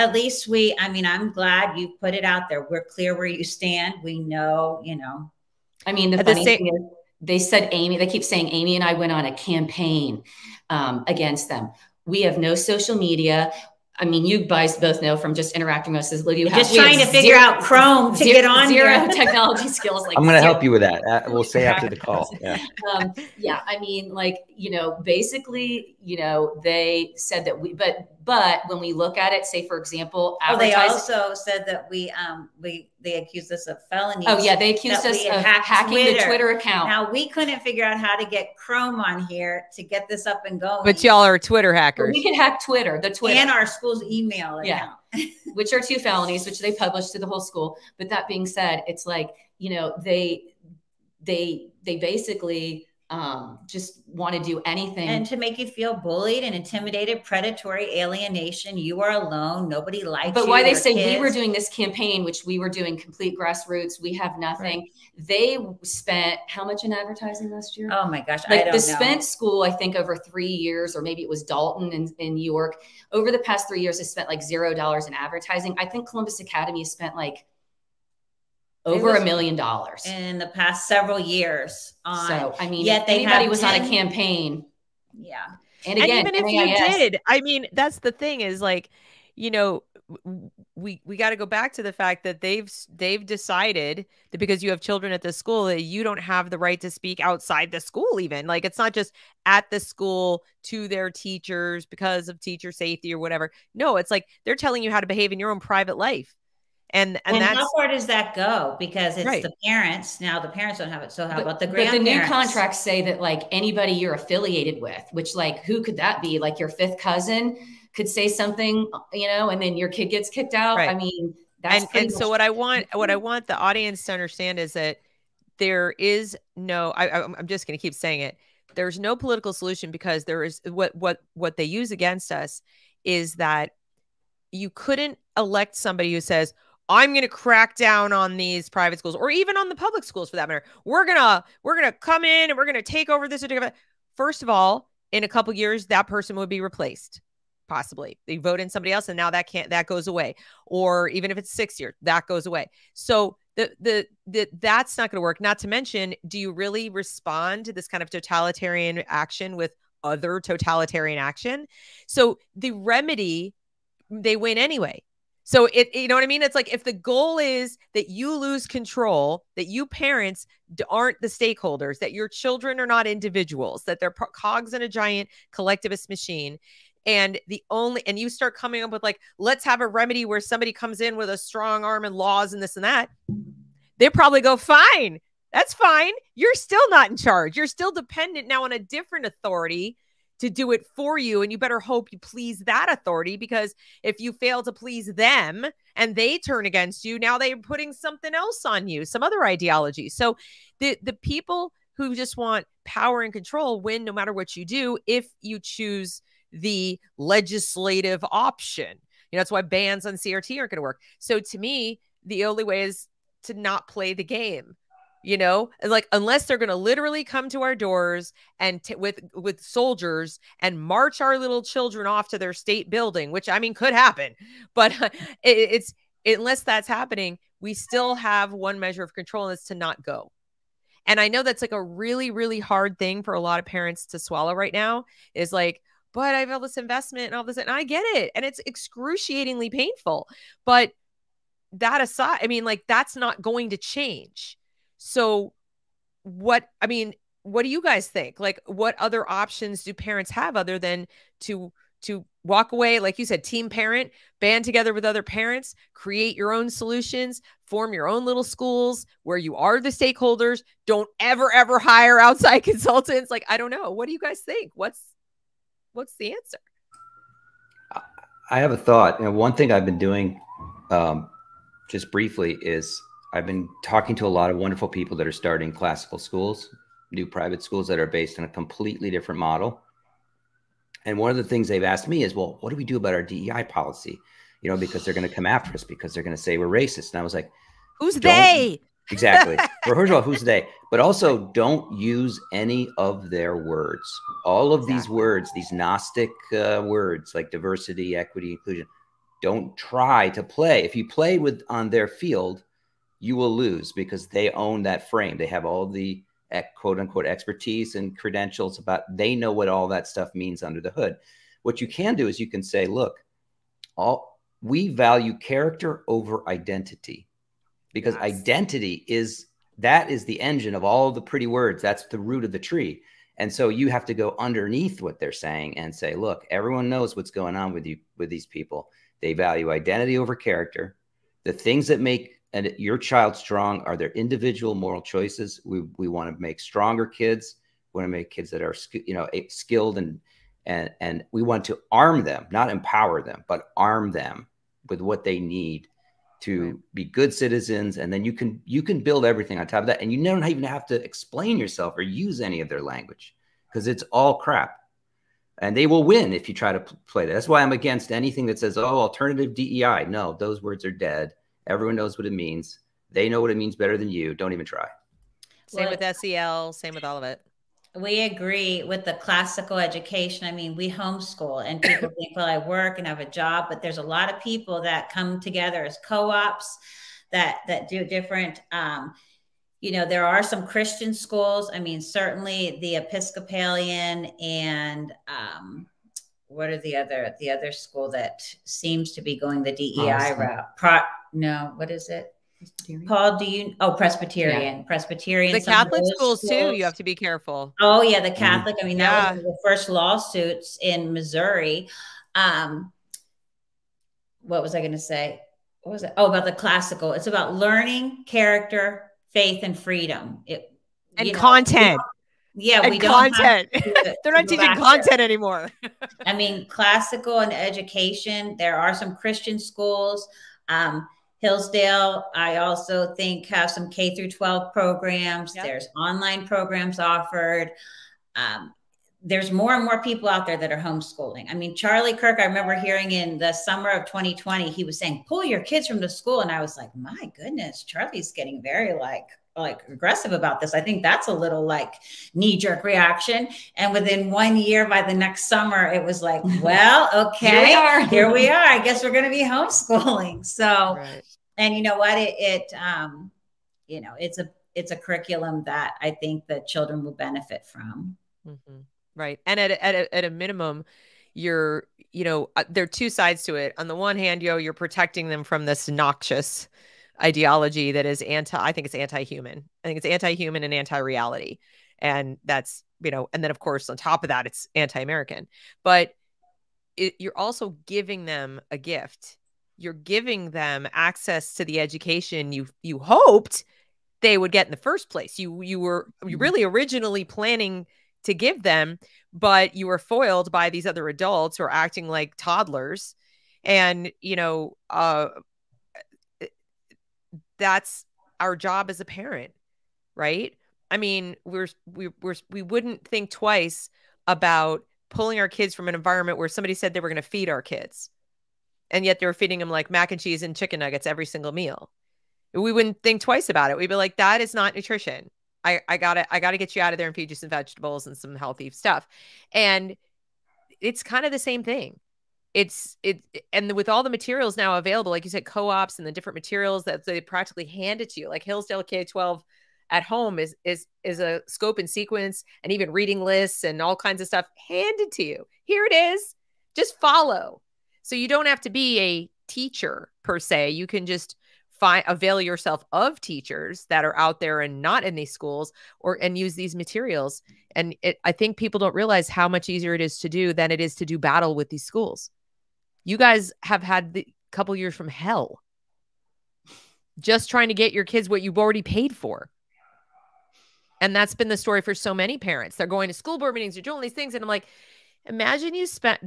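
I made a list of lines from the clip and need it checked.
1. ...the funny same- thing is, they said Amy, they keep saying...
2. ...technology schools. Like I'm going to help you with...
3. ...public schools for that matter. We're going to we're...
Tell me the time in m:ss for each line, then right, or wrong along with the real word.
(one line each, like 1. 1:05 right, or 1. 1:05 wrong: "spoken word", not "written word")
1. 0:06 right
2. 0:19 wrong: "skills", not "schools"
3. 2:19 right.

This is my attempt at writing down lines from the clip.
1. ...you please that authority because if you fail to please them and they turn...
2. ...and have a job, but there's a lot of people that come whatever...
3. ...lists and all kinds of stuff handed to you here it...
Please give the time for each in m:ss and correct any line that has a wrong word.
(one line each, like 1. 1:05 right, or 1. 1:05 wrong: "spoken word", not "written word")
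1. 3:12 right
2. 6:12 wrong: "together", not "whatever"
3. 8:53 right.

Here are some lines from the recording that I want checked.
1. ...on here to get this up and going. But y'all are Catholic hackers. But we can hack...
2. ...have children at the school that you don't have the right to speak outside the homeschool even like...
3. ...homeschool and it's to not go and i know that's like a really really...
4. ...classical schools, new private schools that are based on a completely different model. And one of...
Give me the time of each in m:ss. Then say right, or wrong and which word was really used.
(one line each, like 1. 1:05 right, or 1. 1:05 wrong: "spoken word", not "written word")
1. 0:38 wrong: "Twitter", not "Catholic"
2. 1:34 wrong: "school", not "homeschool"
3. 3:49 wrong: "control", not "homeschool"
4. 4:35 right.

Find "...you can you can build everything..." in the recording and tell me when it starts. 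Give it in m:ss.
5:48.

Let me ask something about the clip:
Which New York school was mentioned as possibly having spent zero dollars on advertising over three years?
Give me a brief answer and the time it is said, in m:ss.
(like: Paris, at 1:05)
Dalton, at 1:11.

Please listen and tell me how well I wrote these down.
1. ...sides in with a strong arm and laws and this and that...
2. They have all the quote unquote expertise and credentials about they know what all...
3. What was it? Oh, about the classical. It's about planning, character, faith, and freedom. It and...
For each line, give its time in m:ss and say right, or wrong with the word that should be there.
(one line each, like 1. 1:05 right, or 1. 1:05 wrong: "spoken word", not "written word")
1. 3:00 wrong: "comes", not "sides"
2. 5:05 right
3. 6:45 wrong: "learning", not "planning".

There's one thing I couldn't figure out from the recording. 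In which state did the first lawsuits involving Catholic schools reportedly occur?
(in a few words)
Missouri.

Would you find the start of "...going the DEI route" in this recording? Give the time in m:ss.
6:29.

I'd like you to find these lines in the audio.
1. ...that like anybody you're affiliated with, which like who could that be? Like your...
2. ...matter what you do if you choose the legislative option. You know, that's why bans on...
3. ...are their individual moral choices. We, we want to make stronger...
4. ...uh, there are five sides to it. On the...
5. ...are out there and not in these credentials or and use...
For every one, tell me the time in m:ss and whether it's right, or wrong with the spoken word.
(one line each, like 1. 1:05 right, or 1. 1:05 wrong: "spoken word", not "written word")
1. 1:53 right
2. 3:24 right
3. 5:33 right
4. 7:42 wrong: "two", not "five"
5. 9:04 wrong: "schools", not "credentials".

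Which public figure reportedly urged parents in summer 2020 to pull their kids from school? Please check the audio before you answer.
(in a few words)
Charlie Kirk.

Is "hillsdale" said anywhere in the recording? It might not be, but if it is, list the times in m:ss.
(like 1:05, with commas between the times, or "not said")
7:01, 8:48.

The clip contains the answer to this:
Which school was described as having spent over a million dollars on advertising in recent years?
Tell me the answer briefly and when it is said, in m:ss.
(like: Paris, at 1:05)
Columbus Academy, at 1:16.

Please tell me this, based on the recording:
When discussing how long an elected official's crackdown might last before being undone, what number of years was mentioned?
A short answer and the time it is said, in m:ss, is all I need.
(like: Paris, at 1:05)
6, at 2:31.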